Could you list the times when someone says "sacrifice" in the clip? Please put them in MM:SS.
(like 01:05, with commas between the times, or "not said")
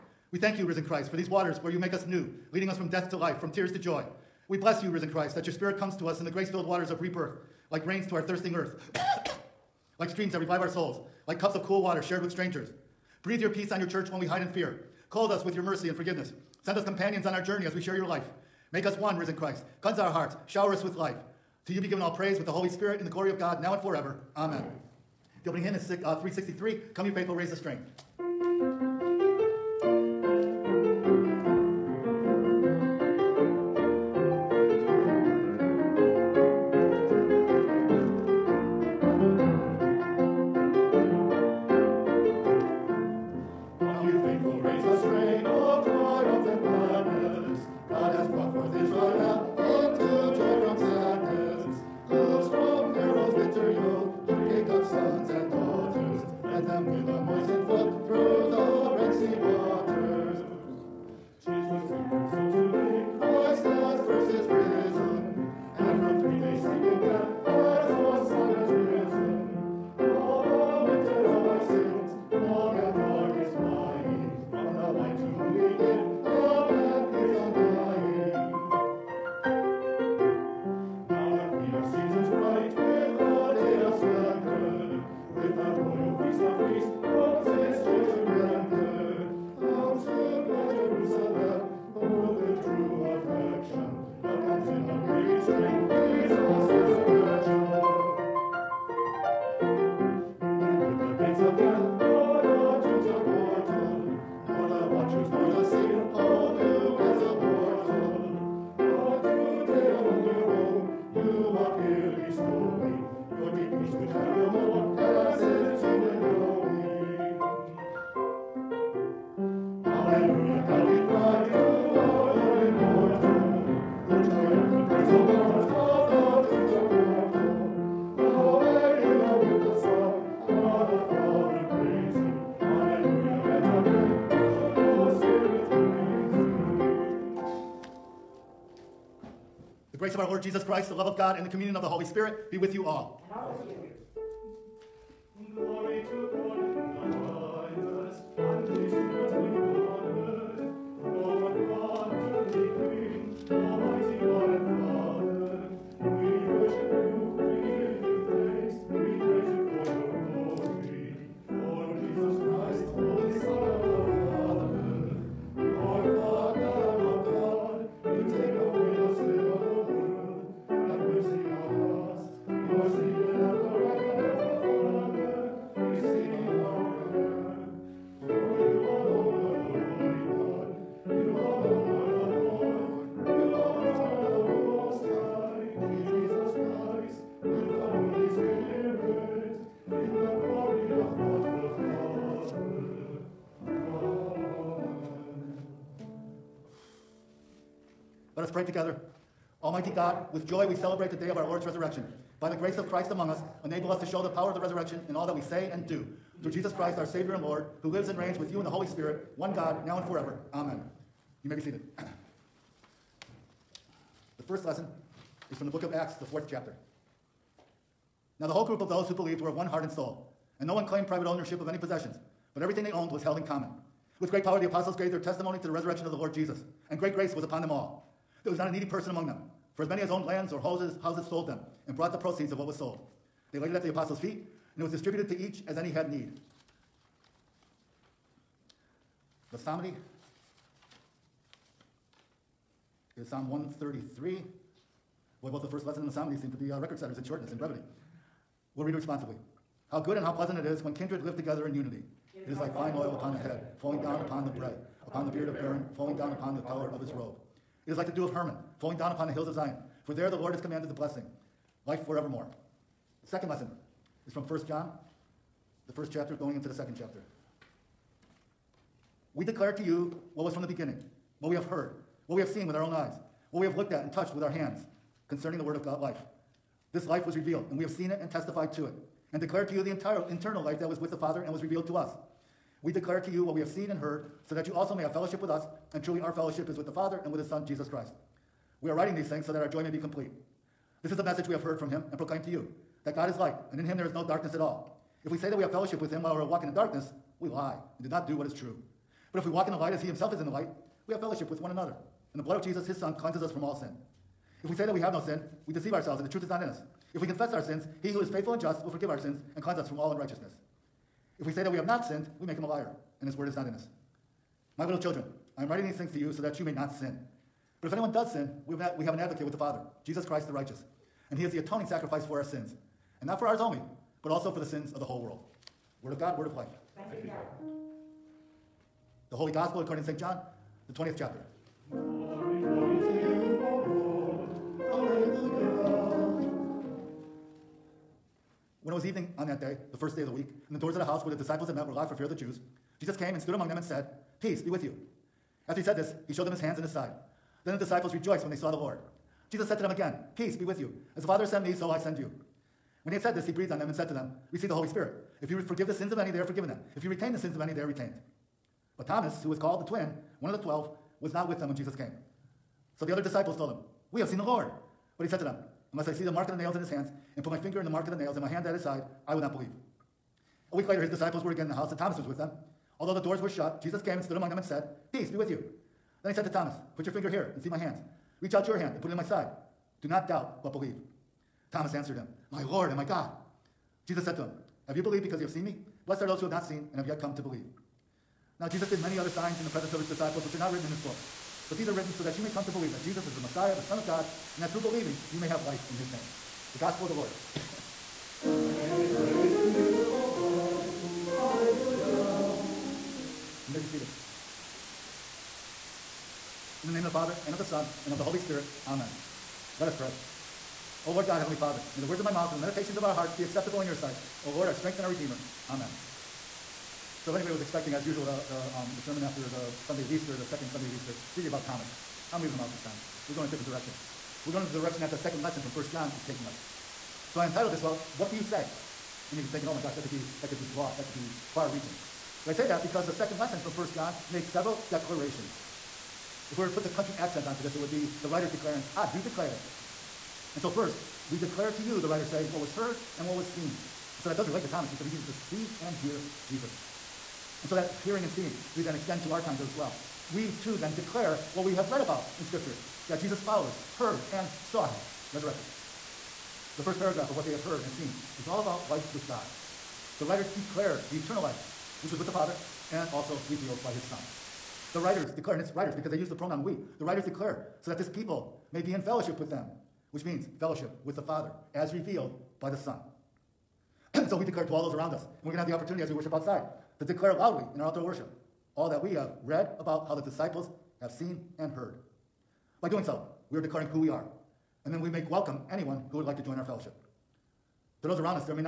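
05:21.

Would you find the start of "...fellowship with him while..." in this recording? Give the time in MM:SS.
04:55.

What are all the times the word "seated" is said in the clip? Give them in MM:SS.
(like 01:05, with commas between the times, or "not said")
03:31, 06:43.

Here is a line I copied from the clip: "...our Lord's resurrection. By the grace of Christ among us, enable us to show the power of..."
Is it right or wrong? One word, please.
right.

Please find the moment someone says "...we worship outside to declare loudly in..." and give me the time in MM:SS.
07:56.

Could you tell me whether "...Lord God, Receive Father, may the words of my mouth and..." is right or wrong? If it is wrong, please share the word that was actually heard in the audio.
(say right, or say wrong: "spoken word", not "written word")
wrong: "Heavenly", not "Receive".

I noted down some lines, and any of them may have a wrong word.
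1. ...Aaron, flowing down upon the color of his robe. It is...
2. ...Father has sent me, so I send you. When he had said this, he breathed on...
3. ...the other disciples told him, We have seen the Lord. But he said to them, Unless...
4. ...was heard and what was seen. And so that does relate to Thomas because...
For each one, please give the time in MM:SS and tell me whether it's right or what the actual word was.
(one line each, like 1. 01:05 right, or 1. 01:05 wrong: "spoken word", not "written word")
1. 04:15 right
2. 05:51 right
3. 06:03 right
4. 07:22 right.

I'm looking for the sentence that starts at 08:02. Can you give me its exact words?
By doing so, we are declaring who we are, and then we make welcome anyone who would like to join our fellowship.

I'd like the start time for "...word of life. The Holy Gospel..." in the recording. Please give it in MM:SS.
05:26.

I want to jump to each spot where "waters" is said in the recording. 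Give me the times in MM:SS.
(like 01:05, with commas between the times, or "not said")
00:01, 00:06, 00:11.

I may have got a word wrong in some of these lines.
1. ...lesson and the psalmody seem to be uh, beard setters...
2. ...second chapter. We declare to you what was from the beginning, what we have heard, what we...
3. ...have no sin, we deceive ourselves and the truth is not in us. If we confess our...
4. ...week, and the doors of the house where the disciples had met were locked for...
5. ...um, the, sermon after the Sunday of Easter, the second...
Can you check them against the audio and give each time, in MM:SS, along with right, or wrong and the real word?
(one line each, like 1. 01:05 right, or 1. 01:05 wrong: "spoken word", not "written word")
1. 04:05 wrong: "record", not "beard"
2. 04:26 right
3. 05:04 right
4. 05:40 right
5. 06:58 right.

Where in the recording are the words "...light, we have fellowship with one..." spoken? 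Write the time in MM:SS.
05:00.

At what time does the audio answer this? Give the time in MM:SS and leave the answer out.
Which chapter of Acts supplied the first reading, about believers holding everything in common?
03:36.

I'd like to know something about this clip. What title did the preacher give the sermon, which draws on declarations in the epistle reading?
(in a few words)
Well, what do you say?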